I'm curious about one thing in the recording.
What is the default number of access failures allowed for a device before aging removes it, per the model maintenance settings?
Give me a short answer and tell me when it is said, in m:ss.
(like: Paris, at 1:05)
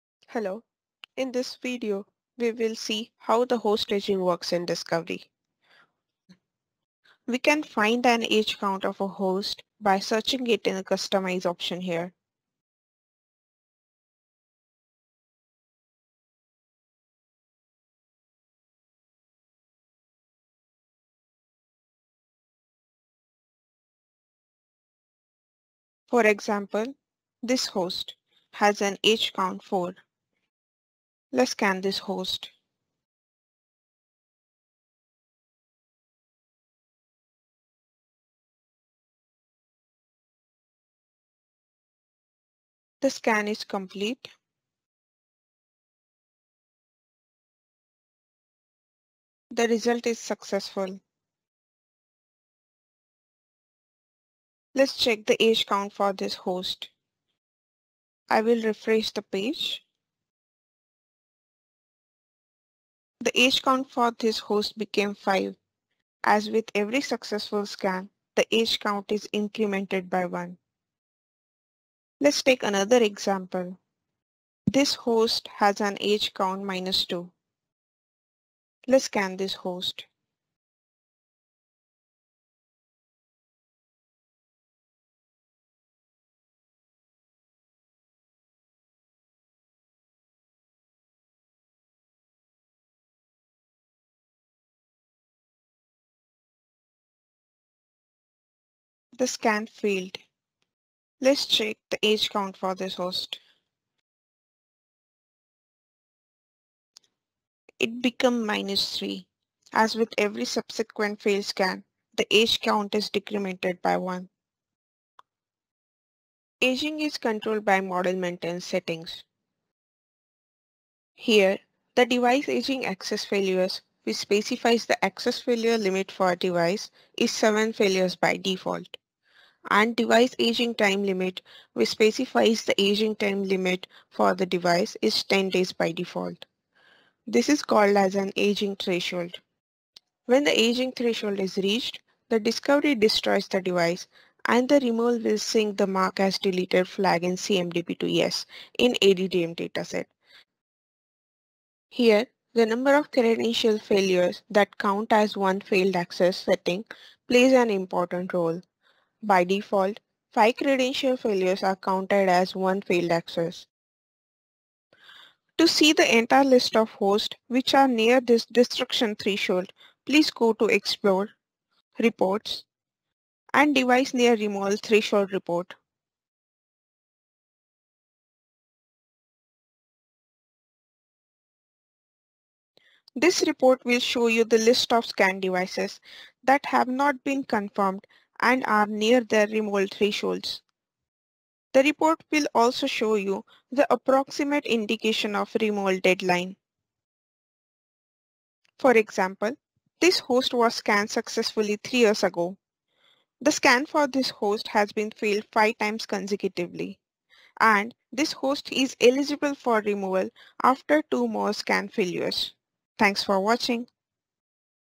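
7, at 2:07.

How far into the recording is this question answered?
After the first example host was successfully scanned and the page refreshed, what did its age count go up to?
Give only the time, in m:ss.
1:05.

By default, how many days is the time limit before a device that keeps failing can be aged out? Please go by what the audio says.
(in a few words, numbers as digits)
10 days.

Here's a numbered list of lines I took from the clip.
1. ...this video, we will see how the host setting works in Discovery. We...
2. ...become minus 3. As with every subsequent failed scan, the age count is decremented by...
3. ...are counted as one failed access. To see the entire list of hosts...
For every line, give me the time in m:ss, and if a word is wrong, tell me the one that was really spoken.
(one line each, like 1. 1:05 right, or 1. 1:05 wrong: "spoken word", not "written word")
1. 0:01 wrong: "aging", not "setting"
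2. 1:48 right
3. 2:41 right.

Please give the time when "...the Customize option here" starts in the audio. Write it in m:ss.
0:10.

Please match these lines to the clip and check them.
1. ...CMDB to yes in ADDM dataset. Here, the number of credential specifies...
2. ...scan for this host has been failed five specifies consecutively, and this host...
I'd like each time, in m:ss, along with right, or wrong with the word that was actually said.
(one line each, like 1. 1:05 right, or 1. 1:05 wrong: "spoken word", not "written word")
1. 2:27 wrong: "failures", not "specifies"
2. 3:23 wrong: "times", not "specifies".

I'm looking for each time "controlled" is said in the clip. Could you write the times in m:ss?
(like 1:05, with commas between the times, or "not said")
1:57.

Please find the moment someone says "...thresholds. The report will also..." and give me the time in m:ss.
3:09.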